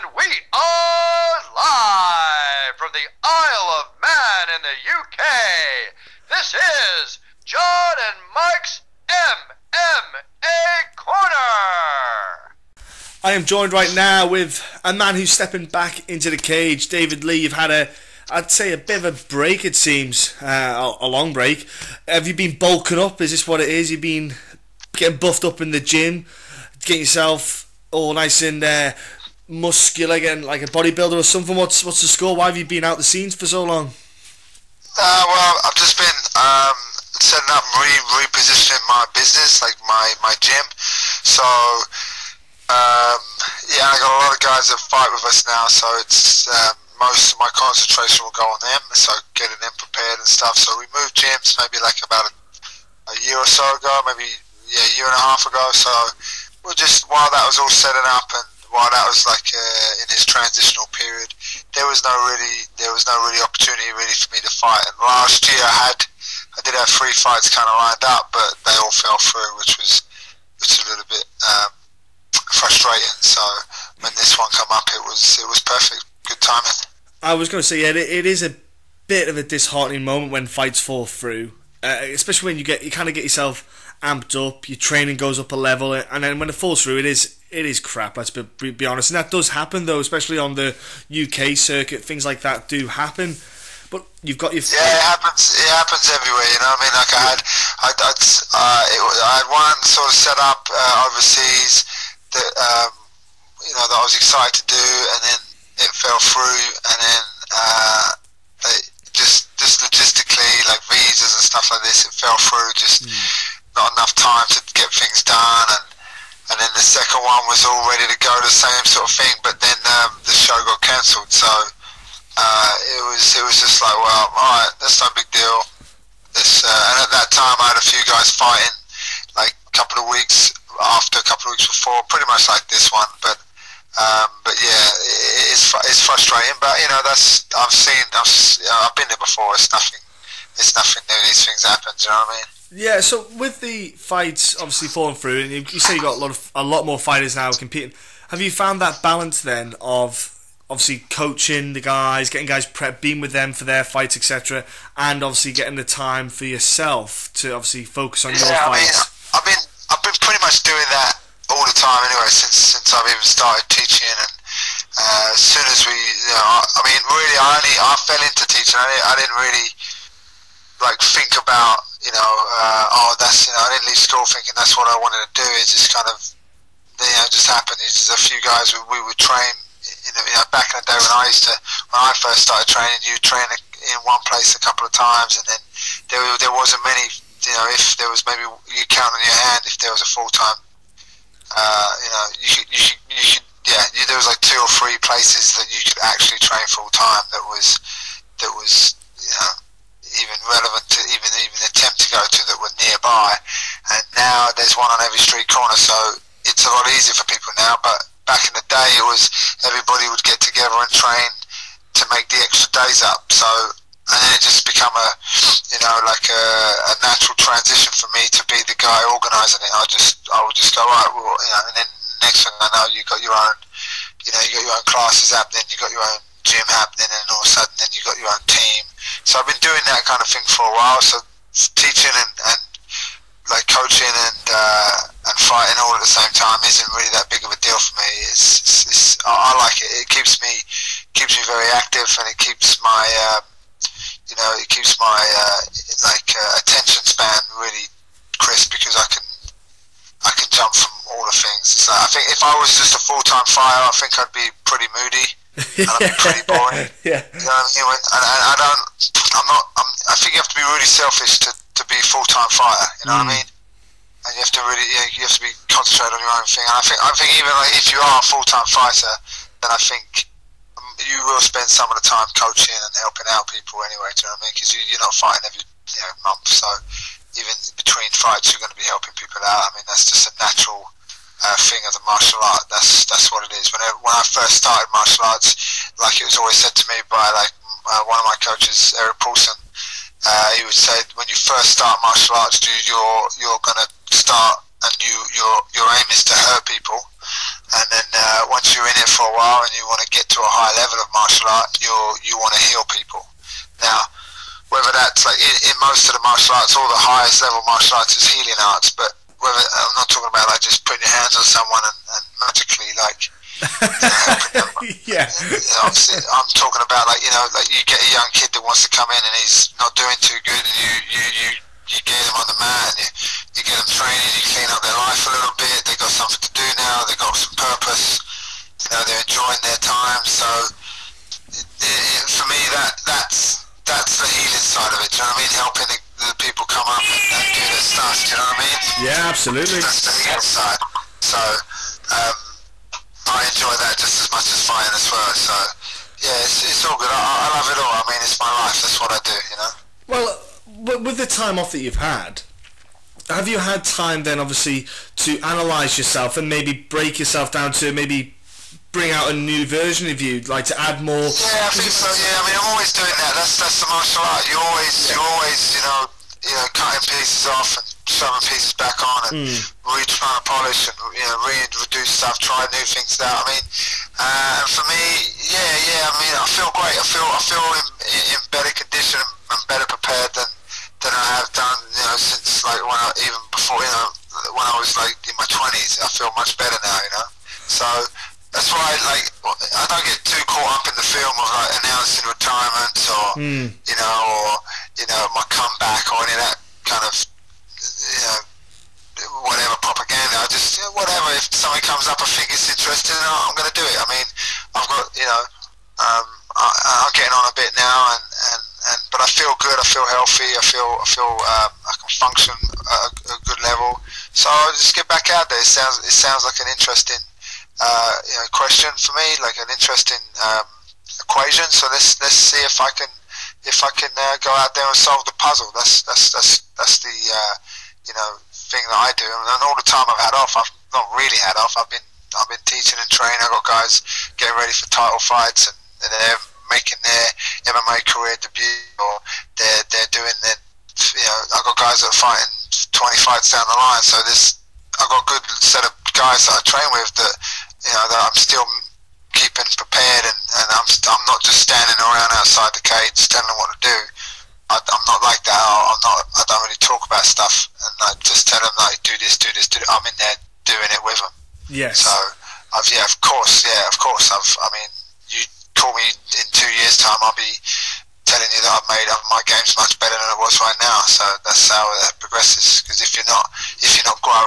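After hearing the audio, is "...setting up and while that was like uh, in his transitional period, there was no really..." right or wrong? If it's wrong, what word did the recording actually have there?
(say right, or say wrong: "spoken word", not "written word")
right.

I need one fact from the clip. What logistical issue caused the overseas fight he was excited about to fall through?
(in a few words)
Visas.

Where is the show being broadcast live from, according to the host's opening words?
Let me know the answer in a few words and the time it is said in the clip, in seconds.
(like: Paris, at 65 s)
Isle of Man, at 3 s.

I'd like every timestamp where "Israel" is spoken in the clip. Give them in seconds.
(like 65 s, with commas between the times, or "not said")
not said.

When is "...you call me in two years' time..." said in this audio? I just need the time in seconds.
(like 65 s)
465 s.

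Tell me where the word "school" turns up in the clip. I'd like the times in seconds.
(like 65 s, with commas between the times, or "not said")
173 s.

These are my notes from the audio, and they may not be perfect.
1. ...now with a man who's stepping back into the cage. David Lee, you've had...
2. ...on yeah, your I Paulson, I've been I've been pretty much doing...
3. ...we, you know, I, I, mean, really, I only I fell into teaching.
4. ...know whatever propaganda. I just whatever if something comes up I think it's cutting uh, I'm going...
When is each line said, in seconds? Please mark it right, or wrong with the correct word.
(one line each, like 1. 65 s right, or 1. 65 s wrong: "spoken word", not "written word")
1. 13 s right
2. 158 s wrong: "Mean", not "Paulson"
3. 165 s right
4. 398 s wrong: "interesting", not "cutting".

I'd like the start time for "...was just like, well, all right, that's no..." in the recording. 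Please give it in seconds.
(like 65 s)
123 s.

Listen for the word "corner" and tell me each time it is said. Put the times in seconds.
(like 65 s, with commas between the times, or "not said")
10 s, 205 s.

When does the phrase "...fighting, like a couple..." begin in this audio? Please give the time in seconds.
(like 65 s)
128 s.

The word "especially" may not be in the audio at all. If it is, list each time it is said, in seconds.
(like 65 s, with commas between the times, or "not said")
82 s, 89 s.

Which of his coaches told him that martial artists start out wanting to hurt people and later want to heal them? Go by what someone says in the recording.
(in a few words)
Erik Paulson.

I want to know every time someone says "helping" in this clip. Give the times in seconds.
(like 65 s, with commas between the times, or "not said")
272 s, 278 s, 335 s.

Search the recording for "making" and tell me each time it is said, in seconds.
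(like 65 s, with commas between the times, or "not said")
436 s.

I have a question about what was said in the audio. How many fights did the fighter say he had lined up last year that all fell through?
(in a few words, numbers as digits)
3.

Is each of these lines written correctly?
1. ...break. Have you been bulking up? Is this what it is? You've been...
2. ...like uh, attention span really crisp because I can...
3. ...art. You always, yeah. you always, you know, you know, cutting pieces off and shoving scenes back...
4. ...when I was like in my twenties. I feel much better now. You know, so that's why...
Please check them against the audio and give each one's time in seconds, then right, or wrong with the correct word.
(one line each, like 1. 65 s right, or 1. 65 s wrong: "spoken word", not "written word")
1. 21 s right
2. 246 s right
3. 364 s wrong: "pieces", not "scenes"
4. 384 s right.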